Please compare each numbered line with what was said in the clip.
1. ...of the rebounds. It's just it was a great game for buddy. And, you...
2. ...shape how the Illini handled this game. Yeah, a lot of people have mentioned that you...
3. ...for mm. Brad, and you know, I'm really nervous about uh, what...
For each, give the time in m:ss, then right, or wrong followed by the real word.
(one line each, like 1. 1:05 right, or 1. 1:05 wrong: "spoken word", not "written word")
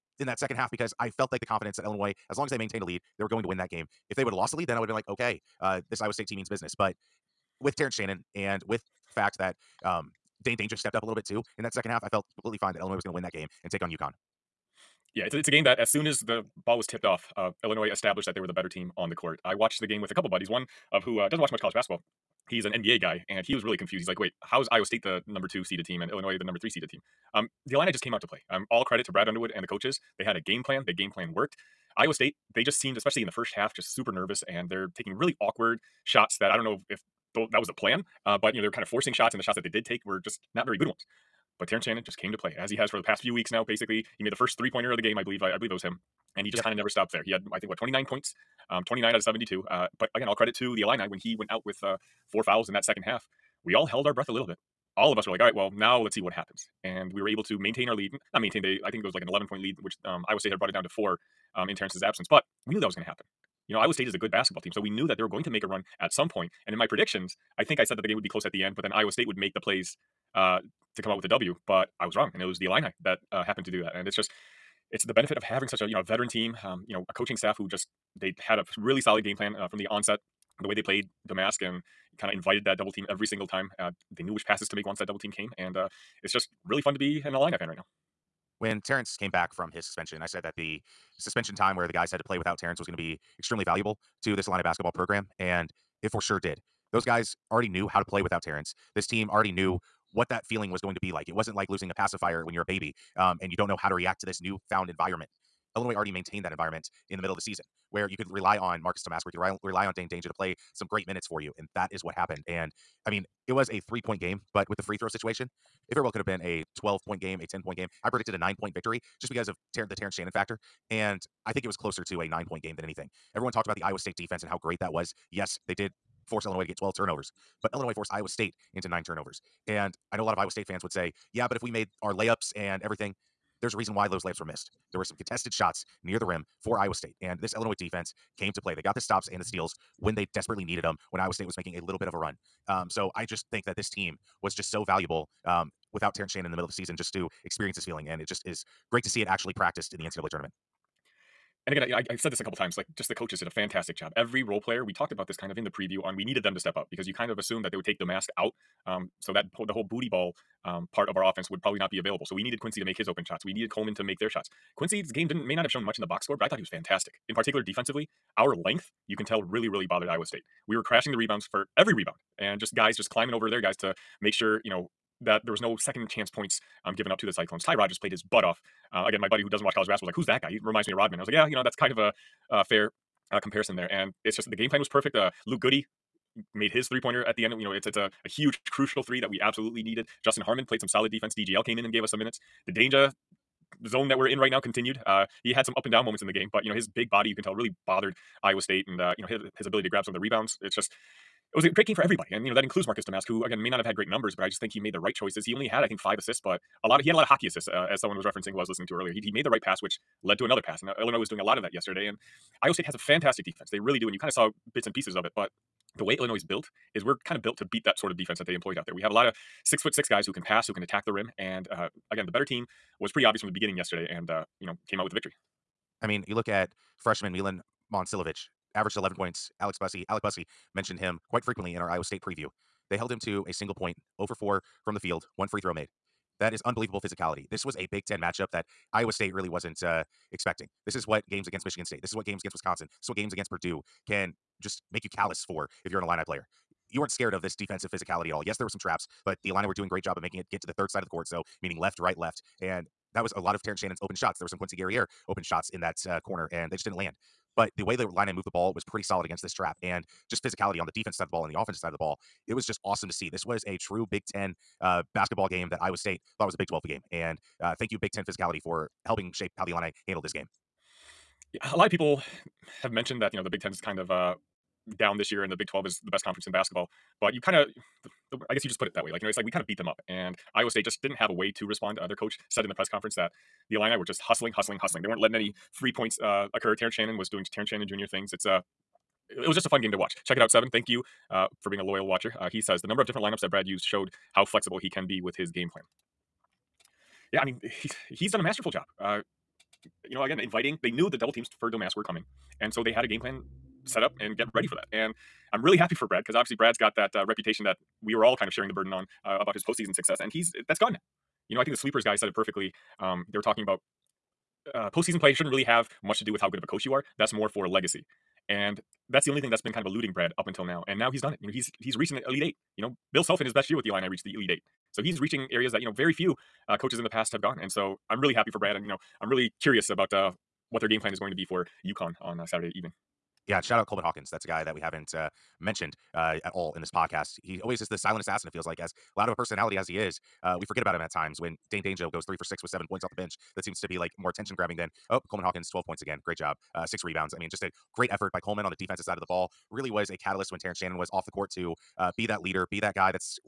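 1. 3:20 wrong: "everybody", not "buddy"
2. 4:29 right
3. 5:28 wrong: "curious", not "nervous".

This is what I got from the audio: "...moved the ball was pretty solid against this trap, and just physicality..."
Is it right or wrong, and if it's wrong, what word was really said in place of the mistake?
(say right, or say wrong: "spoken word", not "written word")
right.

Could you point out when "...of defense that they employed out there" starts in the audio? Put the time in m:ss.
3:38.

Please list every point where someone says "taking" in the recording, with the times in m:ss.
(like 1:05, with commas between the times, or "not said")
0:34.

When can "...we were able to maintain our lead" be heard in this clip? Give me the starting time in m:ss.
0:57.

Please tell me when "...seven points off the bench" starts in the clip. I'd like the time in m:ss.
5:42.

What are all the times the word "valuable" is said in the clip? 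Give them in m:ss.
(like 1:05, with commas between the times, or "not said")
1:33, 2:24.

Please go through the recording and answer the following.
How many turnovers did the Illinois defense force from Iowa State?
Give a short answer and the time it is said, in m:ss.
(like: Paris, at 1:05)
9, at 2:08.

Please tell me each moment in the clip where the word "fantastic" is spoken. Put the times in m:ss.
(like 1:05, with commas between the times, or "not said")
2:33, 2:46, 3:32.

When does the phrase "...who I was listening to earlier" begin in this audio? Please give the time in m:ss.
3:28.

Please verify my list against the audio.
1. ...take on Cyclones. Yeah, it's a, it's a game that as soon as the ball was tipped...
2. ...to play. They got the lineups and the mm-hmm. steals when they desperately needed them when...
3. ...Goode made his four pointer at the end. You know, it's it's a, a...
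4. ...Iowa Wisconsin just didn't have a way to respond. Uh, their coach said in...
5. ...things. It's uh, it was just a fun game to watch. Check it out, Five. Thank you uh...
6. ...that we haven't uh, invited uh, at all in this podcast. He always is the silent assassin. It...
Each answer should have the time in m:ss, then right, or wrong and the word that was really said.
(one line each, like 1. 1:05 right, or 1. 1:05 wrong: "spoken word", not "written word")
1. 0:13 wrong: "UConn", not "Cyclones"
2. 2:18 wrong: "stops", not "lineups"
3. 3:05 wrong: "three", not "four"
4. 4:40 wrong: "State", not "Wisconsin"
5. 4:48 wrong: "Seven", not "Five"
6. 5:34 wrong: "mentioned", not "invited".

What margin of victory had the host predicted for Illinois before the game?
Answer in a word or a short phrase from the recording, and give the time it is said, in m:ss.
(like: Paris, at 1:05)
9 points, at 1:58.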